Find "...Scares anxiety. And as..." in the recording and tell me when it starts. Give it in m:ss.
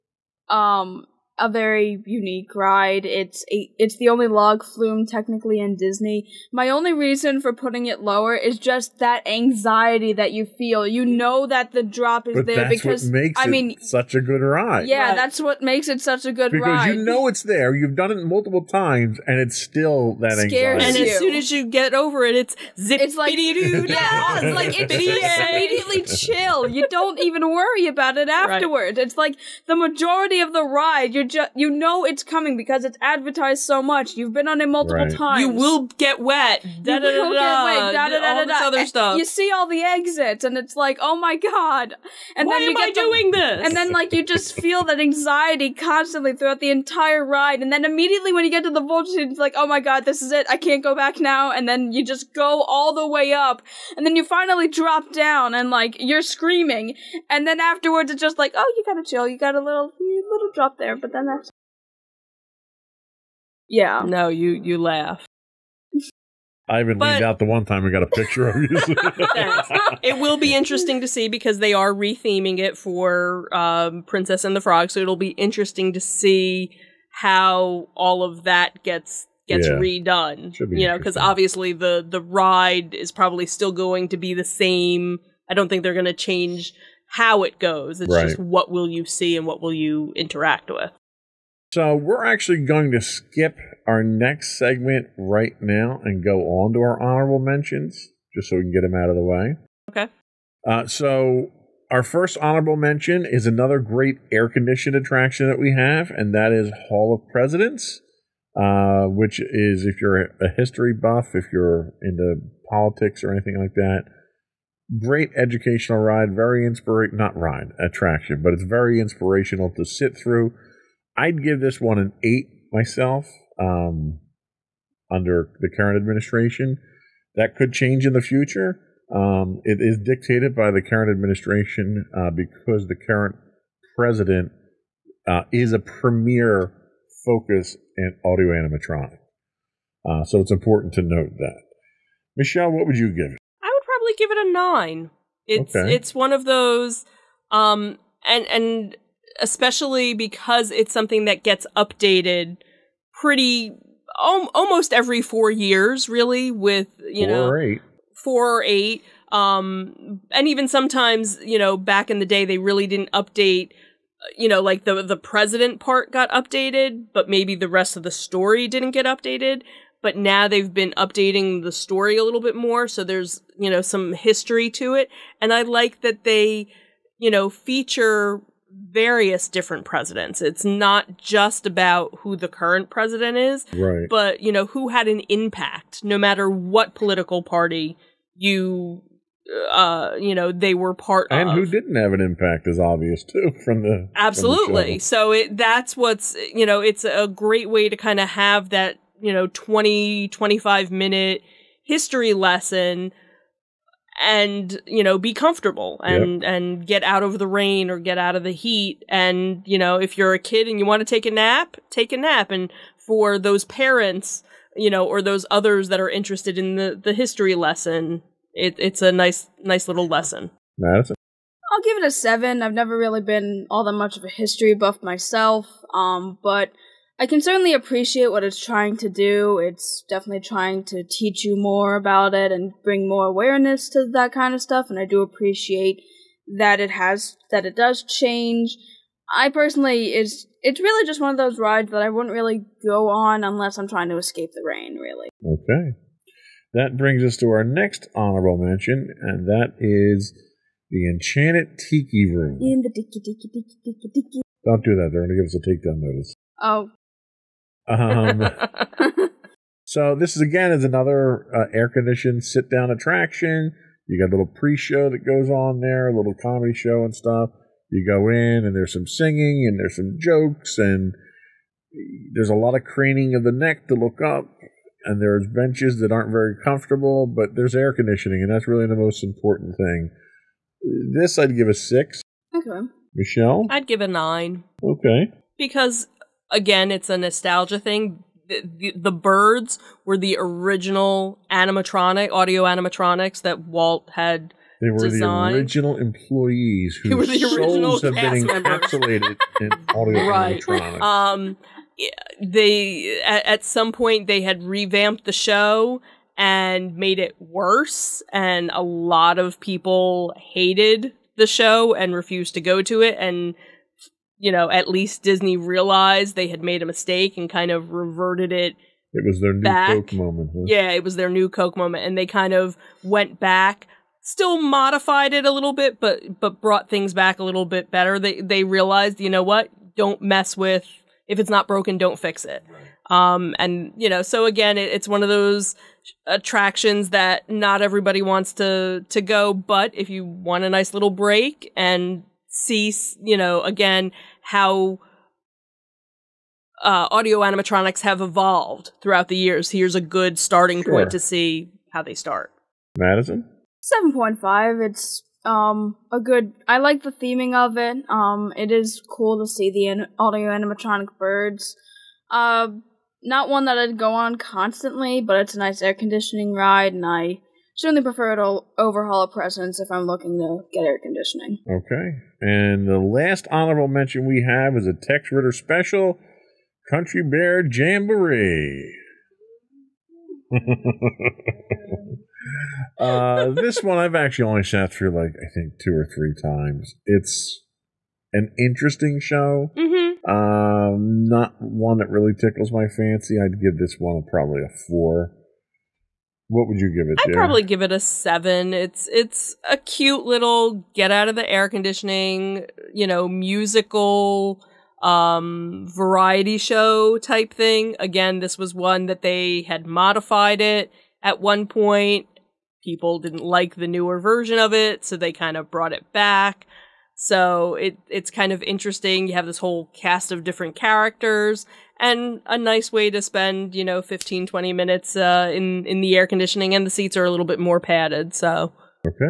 0:20.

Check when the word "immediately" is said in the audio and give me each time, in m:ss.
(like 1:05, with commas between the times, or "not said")
0:24, 0:47.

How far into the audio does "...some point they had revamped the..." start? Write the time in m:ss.
5:03.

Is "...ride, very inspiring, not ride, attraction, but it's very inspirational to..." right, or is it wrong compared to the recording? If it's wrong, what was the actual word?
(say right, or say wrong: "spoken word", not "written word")
right.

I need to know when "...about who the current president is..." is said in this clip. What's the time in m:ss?
3:01.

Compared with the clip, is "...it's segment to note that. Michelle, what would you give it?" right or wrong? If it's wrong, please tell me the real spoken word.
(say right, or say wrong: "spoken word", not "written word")
wrong: "important", not "segment".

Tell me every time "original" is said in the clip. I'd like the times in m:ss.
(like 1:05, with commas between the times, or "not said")
4:50, 4:55.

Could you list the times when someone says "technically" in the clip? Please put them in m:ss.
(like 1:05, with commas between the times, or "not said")
0:05.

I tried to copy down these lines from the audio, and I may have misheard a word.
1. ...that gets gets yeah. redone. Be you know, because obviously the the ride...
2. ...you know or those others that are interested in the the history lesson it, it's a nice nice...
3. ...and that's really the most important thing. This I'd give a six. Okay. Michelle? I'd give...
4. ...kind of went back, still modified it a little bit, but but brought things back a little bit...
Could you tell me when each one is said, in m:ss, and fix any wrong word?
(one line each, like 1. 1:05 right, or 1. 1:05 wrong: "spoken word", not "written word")
1. 1:18 right
2. 3:34 right
3. 4:38 right
4. 5:22 right.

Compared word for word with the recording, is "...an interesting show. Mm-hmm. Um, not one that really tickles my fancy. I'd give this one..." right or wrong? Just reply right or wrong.
right.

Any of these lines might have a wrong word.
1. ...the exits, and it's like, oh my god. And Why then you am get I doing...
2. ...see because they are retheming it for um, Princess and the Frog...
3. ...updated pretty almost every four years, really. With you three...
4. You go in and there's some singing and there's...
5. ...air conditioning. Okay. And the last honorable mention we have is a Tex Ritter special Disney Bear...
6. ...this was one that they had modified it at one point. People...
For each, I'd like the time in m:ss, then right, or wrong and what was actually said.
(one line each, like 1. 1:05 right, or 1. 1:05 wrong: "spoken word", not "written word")
1. 0:39 right
2. 1:11 right
3. 2:31 wrong: "four", not "three"
4. 4:27 right
5. 6:10 wrong: "Country", not "Disney"
6. 6:48 right.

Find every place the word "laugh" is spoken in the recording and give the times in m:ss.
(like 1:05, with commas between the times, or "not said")
1:04.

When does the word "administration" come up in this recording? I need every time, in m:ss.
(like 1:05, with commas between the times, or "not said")
2:05, 2:11.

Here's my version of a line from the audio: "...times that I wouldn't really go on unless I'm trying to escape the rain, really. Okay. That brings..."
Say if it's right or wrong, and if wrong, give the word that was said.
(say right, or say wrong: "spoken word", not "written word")
wrong: "rides", not "times".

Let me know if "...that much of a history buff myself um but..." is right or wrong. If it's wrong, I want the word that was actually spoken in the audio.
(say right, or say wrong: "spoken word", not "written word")
right.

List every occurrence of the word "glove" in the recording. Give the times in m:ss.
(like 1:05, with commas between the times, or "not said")
not said.